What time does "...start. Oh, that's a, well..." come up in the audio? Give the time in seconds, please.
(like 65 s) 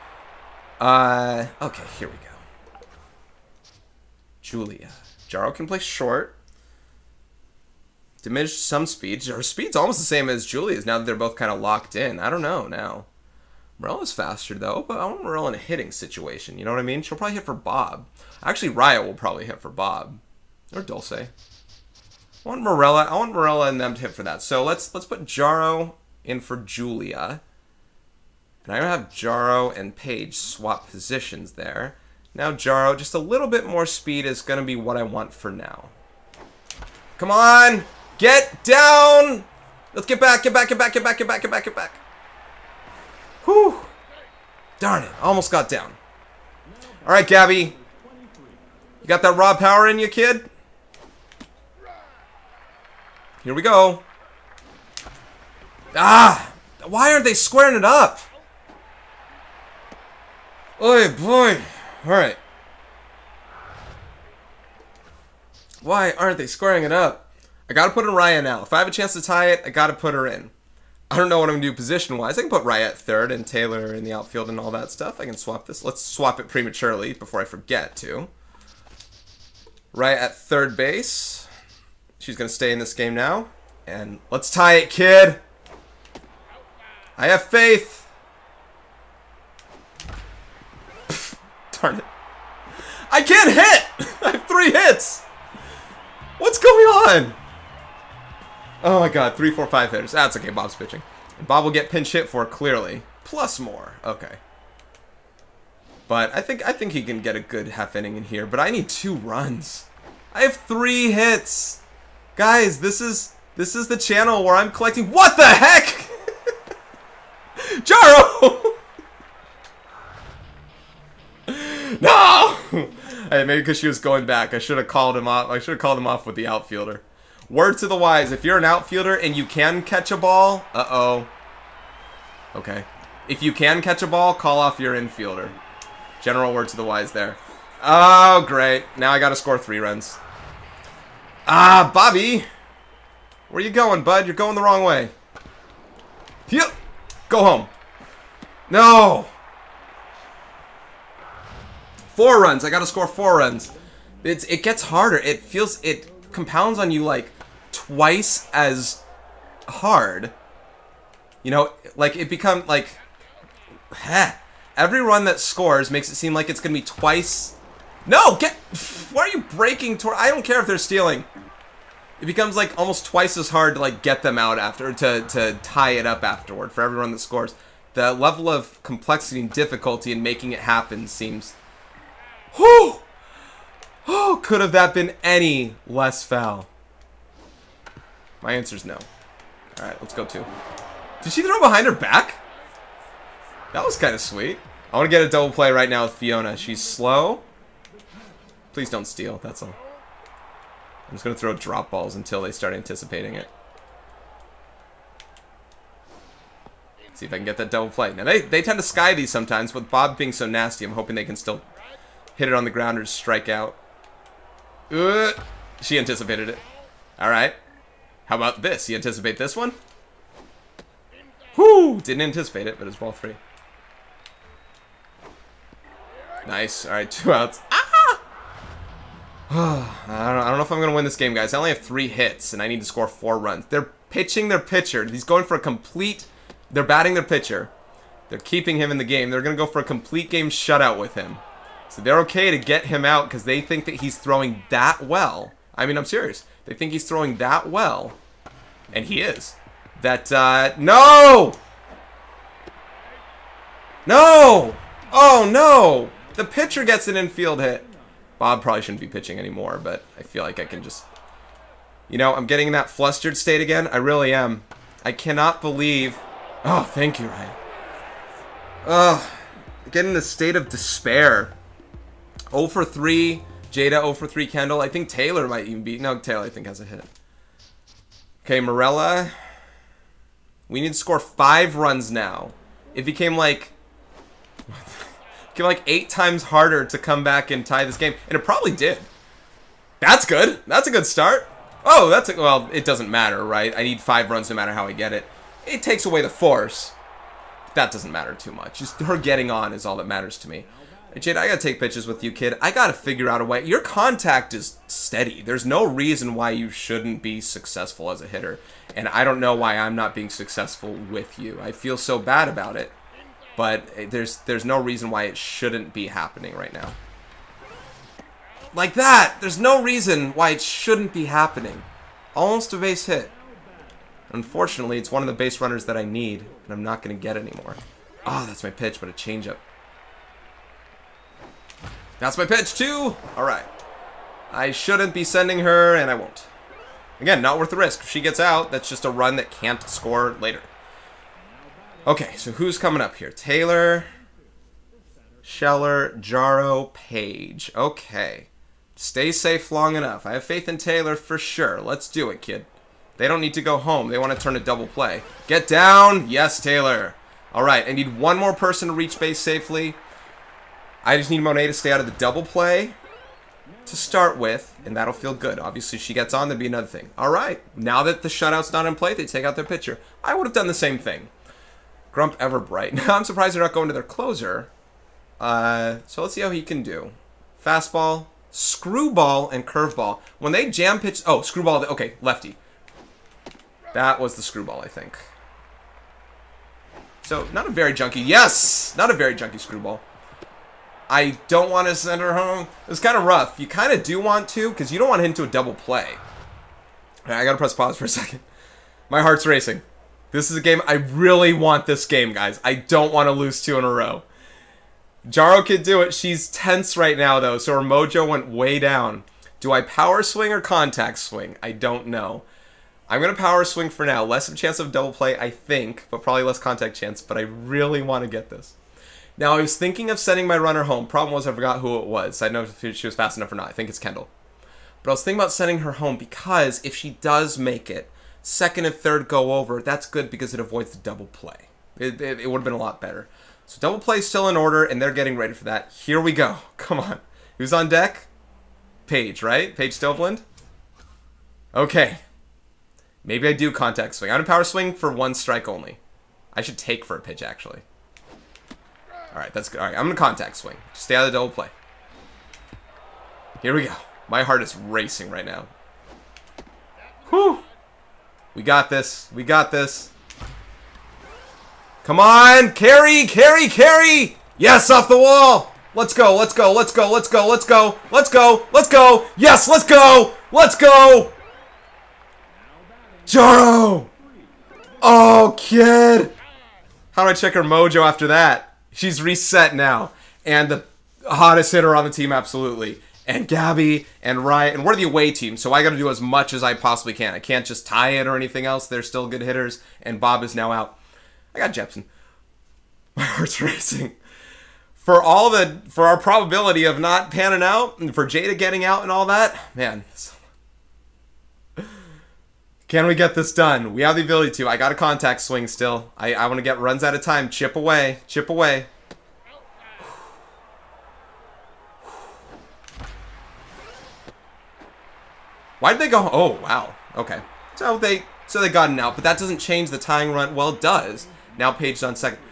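291 s.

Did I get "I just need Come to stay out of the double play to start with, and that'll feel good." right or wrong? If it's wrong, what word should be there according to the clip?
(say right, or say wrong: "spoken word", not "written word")
wrong: "Monet", not "Come".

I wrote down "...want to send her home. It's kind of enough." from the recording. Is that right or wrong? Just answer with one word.
wrong.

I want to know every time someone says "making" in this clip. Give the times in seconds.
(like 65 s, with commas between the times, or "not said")
180 s.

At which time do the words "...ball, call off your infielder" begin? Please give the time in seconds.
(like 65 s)
134 s.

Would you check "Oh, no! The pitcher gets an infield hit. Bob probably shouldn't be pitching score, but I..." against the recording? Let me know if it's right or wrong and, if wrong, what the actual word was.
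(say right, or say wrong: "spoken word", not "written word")
wrong: "anymore", not "score".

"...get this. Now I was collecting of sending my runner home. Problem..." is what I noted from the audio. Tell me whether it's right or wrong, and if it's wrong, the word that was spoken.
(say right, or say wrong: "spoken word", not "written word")
wrong: "thinking", not "collecting".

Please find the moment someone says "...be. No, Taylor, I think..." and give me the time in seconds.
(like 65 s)
275 s.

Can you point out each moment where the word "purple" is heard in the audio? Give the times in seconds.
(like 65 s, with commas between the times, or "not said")
not said.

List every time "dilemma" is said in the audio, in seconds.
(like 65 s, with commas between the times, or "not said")
not said.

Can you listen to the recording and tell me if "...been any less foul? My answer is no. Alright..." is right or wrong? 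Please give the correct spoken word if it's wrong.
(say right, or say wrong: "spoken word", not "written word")
right.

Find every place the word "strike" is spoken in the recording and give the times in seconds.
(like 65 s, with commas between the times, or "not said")
213 s, 445 s.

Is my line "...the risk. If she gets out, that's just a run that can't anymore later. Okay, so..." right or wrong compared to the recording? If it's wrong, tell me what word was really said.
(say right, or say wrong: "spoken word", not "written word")
wrong: "score", not "anymore".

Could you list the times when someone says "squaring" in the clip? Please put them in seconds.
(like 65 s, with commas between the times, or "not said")
57 s, 66 s.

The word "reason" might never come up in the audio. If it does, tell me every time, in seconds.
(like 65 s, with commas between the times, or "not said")
305 s, 314 s, 319 s.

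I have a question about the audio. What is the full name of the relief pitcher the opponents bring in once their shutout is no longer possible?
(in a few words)
Grump Everbright.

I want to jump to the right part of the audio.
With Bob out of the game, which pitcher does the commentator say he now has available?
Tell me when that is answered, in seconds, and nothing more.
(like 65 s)
491 s.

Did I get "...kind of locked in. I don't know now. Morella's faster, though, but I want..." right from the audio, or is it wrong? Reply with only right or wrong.
right.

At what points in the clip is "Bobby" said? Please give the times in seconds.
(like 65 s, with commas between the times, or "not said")
141 s.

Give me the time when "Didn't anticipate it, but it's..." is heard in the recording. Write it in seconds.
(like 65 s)
222 s.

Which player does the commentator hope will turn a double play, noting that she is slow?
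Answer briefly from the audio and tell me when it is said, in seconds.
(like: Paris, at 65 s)
Fiona, at 196 s.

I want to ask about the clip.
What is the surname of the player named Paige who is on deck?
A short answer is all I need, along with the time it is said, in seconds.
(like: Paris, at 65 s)
Stovland, at 439 s.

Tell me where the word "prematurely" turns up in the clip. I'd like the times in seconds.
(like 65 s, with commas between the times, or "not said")
76 s.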